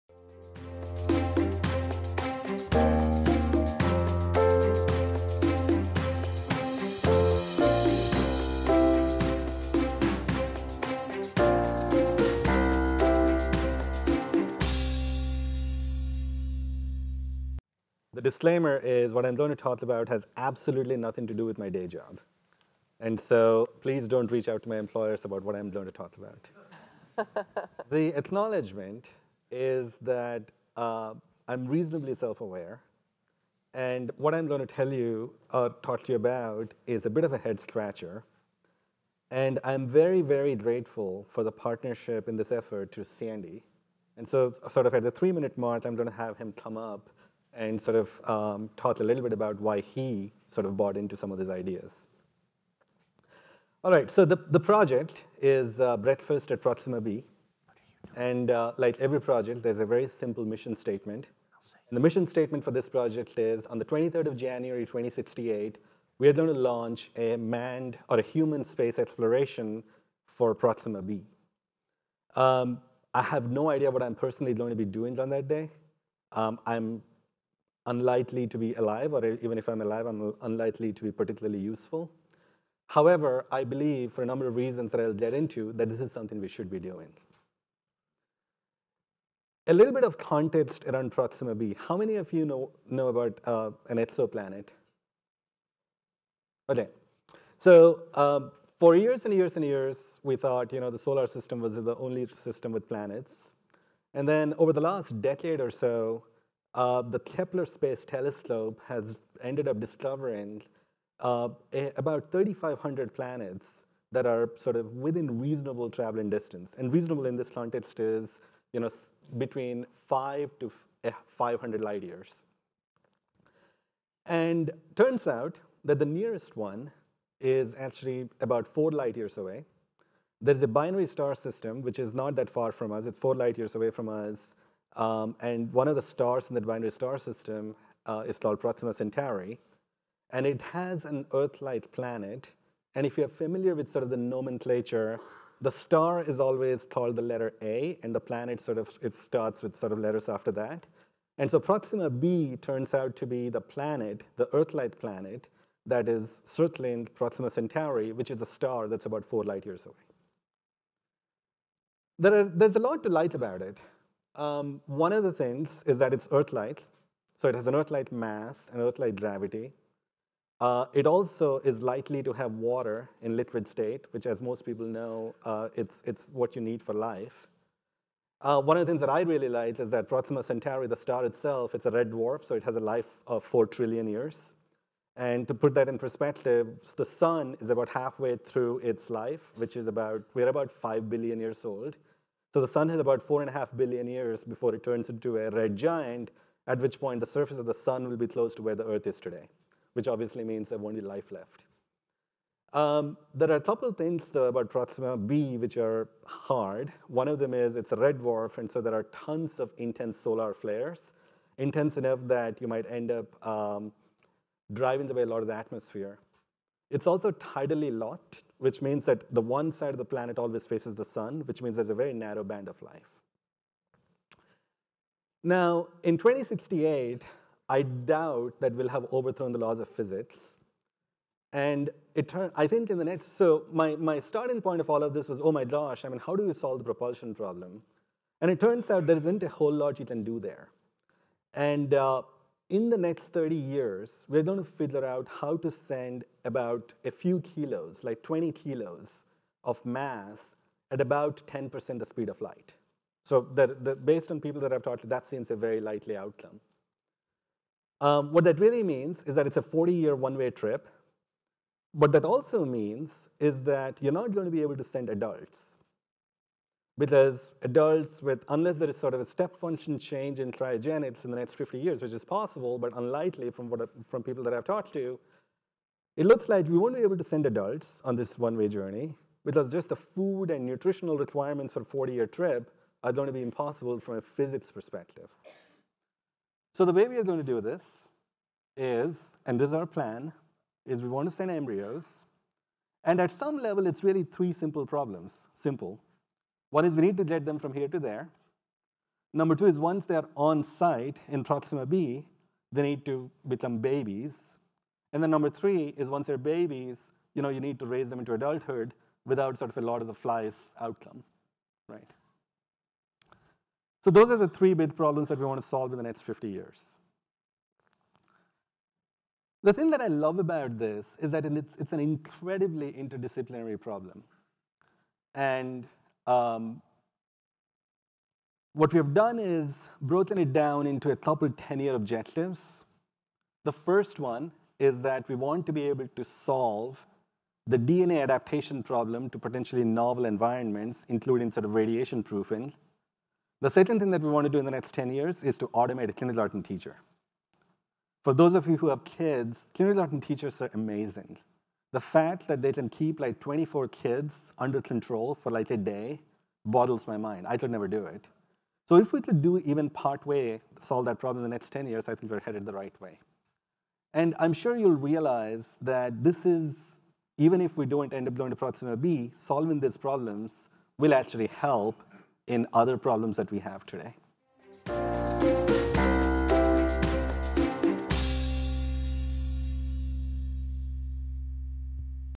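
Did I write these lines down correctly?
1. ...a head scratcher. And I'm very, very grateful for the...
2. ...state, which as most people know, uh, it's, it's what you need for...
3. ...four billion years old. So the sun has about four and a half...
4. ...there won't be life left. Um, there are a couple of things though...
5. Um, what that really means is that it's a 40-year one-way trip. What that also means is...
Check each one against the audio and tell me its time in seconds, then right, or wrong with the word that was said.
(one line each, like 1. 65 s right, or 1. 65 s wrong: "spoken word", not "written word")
1. 37 s right
2. 173 s right
3. 190 s wrong: "five", not "four"
4. 200 s right
5. 257 s right.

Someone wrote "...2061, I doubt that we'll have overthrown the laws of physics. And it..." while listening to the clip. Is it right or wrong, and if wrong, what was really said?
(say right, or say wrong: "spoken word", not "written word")
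wrong: "2068", not "2061".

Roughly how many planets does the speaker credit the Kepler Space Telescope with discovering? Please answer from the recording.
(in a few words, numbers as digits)
3,500.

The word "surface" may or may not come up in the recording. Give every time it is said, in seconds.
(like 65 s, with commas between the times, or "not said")
197 s.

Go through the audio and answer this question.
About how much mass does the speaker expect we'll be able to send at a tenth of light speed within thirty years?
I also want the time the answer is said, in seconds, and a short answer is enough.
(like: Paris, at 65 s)
20 kilos, at 248 s.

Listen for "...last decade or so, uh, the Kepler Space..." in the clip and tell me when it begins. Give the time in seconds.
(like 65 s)
104 s.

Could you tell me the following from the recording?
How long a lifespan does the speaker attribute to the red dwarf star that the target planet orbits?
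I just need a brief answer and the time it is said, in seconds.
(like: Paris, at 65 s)
4 trillion years, at 183 s.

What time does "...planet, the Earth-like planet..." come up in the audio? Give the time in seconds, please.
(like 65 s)
153 s.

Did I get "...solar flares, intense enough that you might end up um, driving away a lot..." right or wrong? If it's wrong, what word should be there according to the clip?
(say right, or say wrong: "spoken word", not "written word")
right.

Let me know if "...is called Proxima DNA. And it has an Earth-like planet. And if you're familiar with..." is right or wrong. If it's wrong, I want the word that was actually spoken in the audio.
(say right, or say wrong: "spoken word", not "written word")
wrong: "Centauri", not "DNA".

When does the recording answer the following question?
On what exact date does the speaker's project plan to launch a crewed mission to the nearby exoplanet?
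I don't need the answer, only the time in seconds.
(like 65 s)
63 s.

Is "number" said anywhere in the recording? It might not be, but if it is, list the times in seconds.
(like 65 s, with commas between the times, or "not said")
84 s, 299 s, 305 s.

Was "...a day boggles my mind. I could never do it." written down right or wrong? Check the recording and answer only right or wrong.
right.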